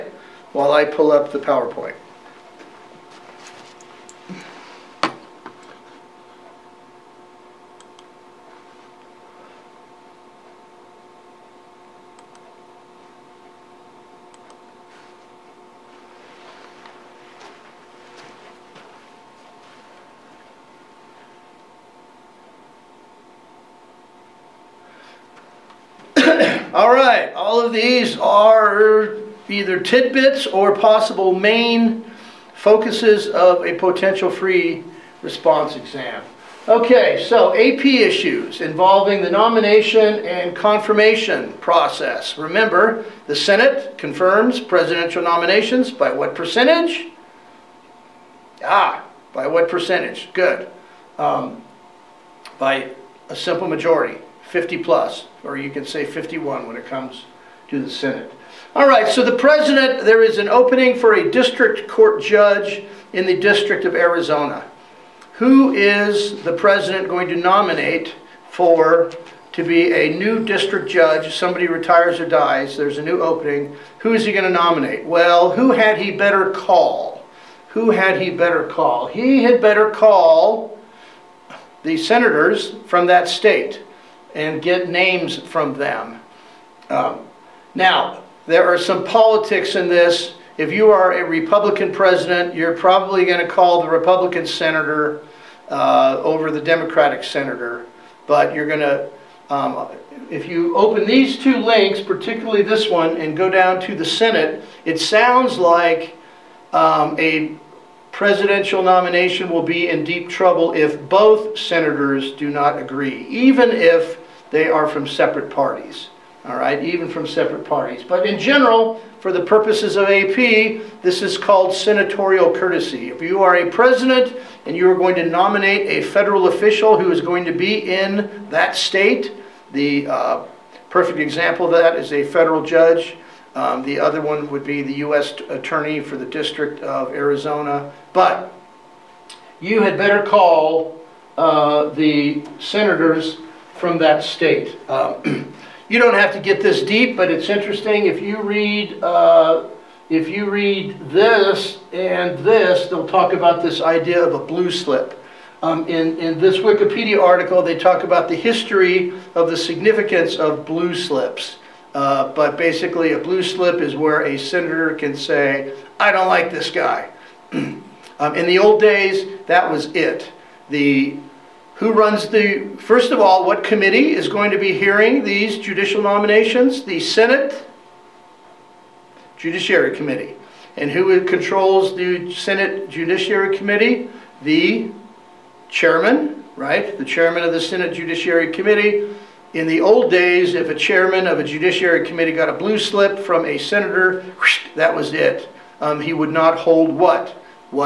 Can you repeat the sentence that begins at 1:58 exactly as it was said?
But in general, for the purposes of AP, this is called senatorial courtesy.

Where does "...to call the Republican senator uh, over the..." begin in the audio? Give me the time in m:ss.
1:33.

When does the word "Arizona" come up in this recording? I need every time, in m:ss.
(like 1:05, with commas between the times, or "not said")
1:03, 2:17.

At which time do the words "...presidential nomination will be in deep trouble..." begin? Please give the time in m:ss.
1:48.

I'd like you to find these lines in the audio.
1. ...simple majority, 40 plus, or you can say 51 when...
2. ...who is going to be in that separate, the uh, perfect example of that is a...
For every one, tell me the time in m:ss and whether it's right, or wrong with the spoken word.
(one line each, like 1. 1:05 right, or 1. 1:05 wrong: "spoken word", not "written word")
1. 0:53 wrong: "50", not "40"
2. 2:06 wrong: "state", not "separate".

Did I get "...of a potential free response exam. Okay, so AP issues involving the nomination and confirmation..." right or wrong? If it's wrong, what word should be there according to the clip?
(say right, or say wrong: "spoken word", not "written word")
right.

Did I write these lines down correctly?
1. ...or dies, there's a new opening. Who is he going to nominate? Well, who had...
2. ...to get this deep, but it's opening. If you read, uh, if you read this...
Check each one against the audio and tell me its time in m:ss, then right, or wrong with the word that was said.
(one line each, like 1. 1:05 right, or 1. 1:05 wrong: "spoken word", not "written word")
1. 1:12 right
2. 2:26 wrong: "interesting", not "opening".